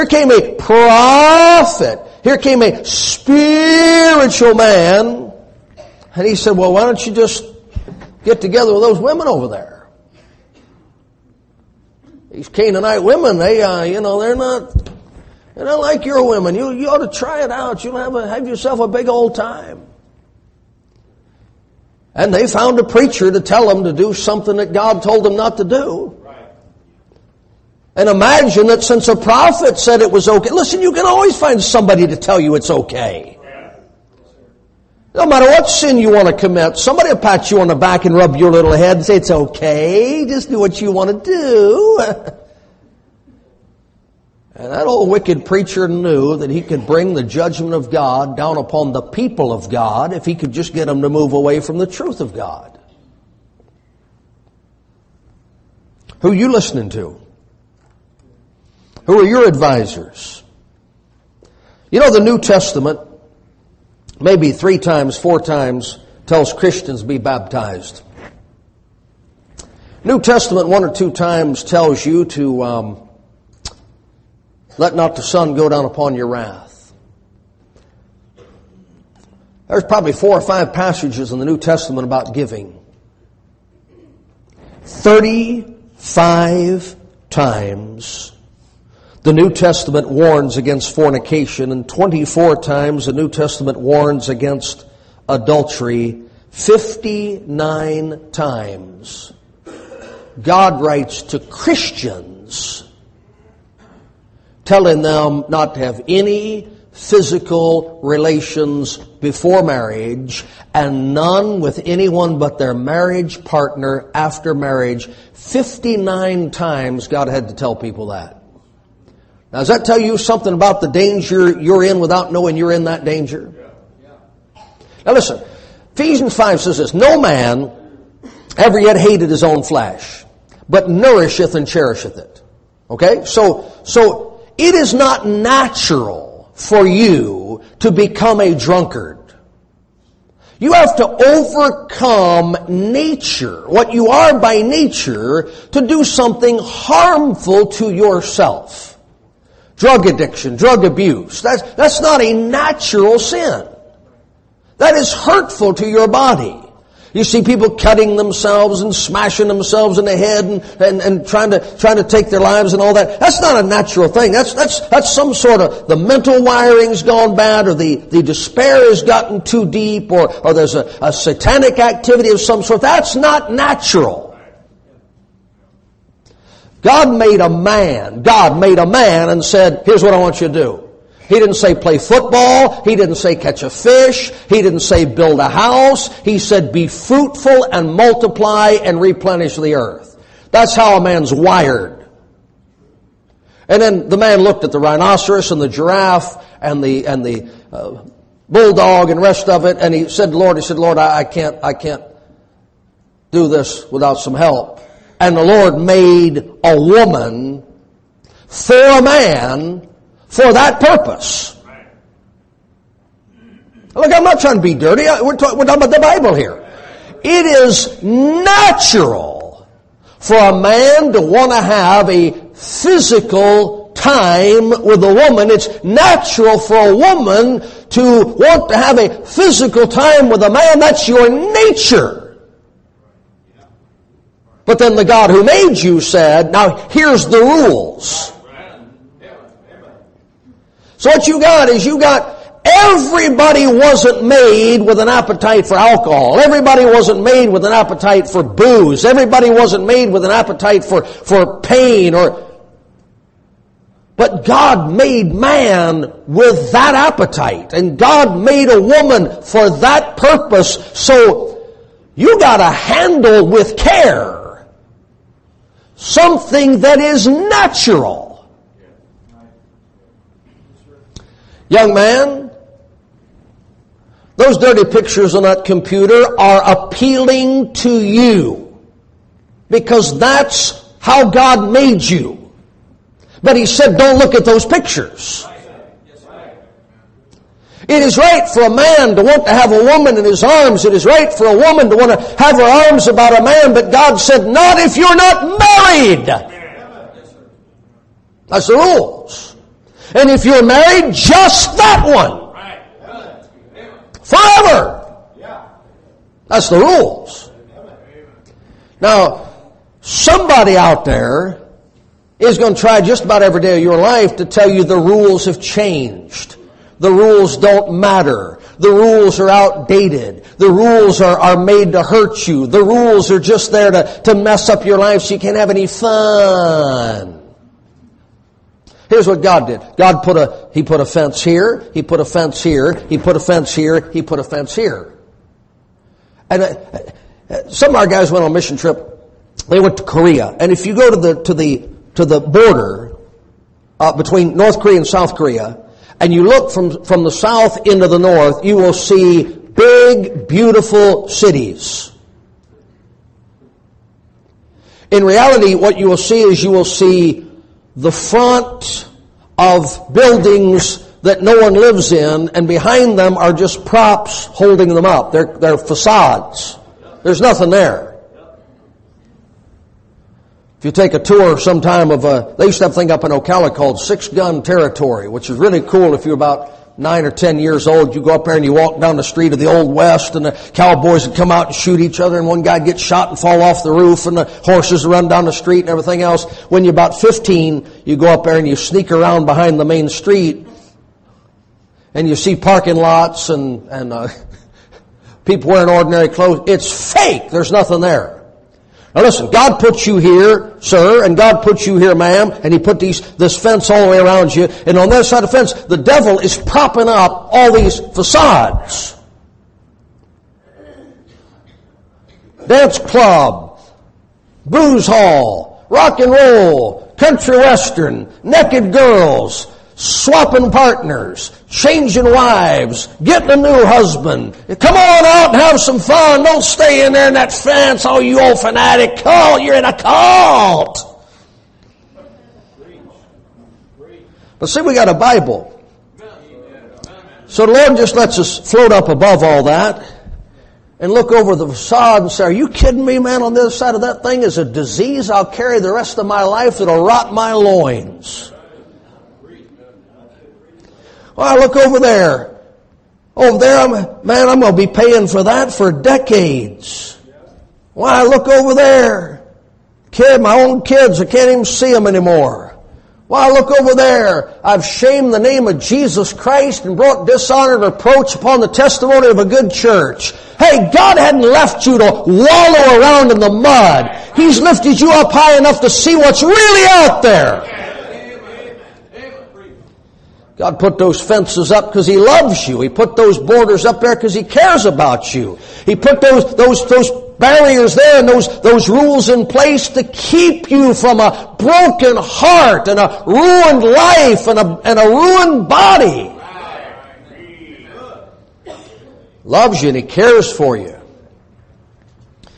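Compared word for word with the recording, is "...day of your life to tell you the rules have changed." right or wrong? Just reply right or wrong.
right.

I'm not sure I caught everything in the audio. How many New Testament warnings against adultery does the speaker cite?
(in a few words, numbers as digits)
24.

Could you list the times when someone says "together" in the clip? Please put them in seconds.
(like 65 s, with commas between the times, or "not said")
8 s.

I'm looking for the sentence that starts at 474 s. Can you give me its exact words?
He's lifted you up high enough to see what's really out there.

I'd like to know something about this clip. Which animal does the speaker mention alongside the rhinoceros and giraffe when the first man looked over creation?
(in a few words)
bulldog.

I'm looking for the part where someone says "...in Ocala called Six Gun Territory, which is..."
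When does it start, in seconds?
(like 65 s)
373 s.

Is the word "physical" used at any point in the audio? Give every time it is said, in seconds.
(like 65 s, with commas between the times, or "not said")
106 s, 222 s, 229 s.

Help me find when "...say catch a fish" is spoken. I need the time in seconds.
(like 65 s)
183 s.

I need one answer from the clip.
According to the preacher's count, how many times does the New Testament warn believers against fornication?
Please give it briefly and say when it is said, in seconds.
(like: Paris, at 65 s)
35, at 84 s.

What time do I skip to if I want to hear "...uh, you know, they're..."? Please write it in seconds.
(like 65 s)
13 s.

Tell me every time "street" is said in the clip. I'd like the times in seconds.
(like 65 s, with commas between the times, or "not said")
379 s, 385 s, 390 s.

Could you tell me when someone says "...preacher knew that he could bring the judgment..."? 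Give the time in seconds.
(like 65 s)
45 s.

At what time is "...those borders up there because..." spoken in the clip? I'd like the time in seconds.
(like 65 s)
483 s.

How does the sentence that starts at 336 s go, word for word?
And uh, uh, some of our guys went on a mission trip.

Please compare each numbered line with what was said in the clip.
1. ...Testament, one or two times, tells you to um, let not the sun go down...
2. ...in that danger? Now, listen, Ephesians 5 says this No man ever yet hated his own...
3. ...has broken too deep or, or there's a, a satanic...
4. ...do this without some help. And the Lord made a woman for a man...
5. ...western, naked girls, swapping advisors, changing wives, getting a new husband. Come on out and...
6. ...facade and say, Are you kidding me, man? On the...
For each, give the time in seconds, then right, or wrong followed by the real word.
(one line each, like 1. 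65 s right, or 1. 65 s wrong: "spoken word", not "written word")
1. 70 s right
2. 122 s right
3. 168 s wrong: "gotten", not "broken"
4. 203 s right
5. 417 s wrong: "partners", not "advisors"
6. 441 s right.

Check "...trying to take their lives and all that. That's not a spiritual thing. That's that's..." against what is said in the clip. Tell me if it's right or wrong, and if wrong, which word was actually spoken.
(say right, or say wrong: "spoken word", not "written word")
wrong: "natural", not "spiritual".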